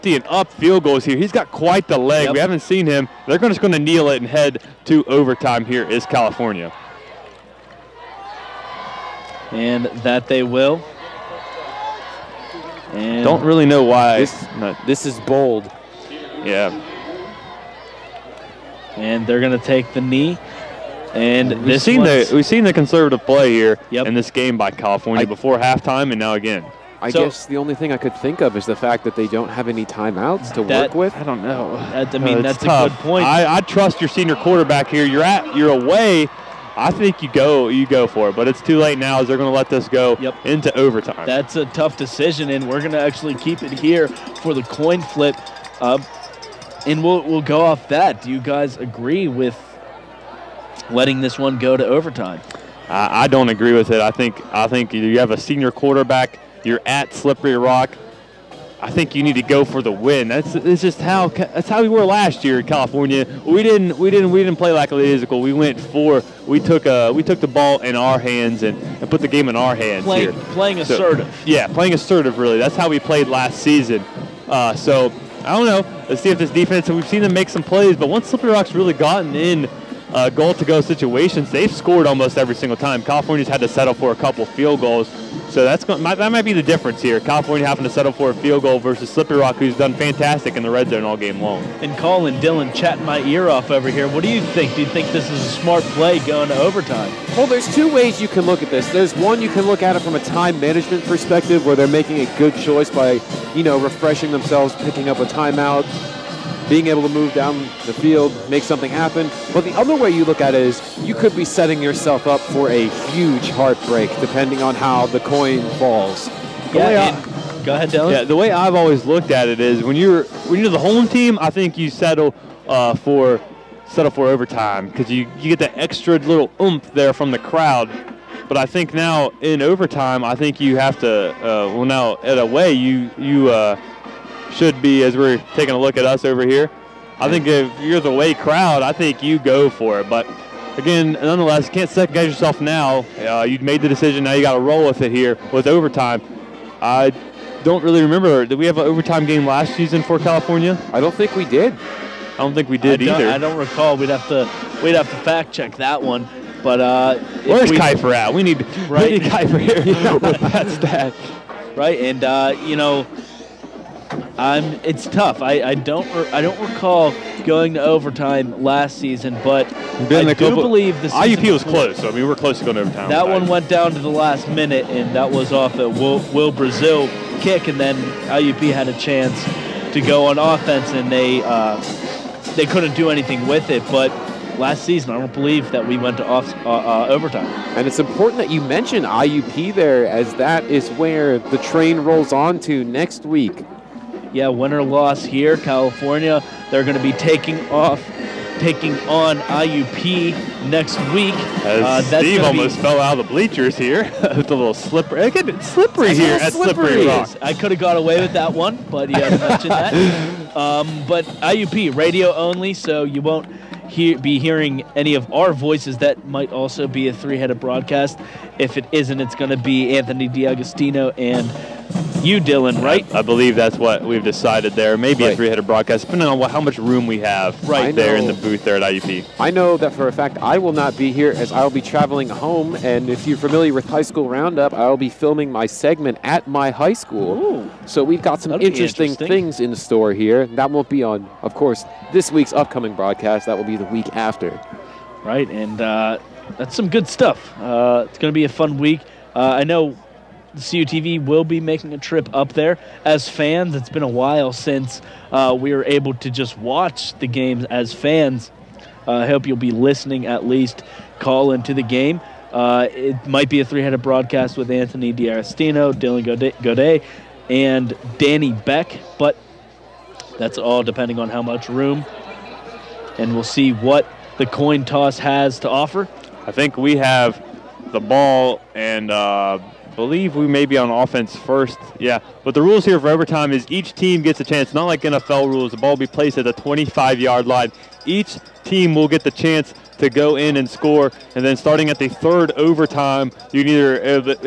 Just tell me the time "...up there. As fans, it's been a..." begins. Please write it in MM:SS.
04:12.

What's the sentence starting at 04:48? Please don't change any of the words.
Each team will get the chance to go in and score.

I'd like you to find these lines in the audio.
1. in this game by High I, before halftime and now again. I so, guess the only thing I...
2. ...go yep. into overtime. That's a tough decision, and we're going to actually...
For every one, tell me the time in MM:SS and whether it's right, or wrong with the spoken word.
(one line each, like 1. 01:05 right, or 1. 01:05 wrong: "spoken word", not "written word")
1. 00:24 wrong: "California", not "High"
2. 00:39 right.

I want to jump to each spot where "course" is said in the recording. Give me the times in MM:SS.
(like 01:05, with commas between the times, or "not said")
04:01.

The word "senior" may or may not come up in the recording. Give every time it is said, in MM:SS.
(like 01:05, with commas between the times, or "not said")
00:34, 00:55.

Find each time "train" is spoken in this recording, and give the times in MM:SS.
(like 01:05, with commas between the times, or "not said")
03:11.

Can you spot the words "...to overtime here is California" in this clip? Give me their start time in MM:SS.
00:04.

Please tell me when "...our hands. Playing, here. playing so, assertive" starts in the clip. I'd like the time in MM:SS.
01:09.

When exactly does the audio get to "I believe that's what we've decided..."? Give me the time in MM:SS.
03:43.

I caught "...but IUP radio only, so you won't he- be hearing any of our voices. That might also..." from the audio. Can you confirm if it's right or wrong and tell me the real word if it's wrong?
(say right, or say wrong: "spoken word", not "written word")
right.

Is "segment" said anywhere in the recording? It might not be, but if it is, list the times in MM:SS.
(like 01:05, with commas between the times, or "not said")
03:55.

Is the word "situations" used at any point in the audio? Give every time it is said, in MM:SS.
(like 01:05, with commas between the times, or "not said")
01:20.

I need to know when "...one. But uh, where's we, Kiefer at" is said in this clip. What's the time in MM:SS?
02:36.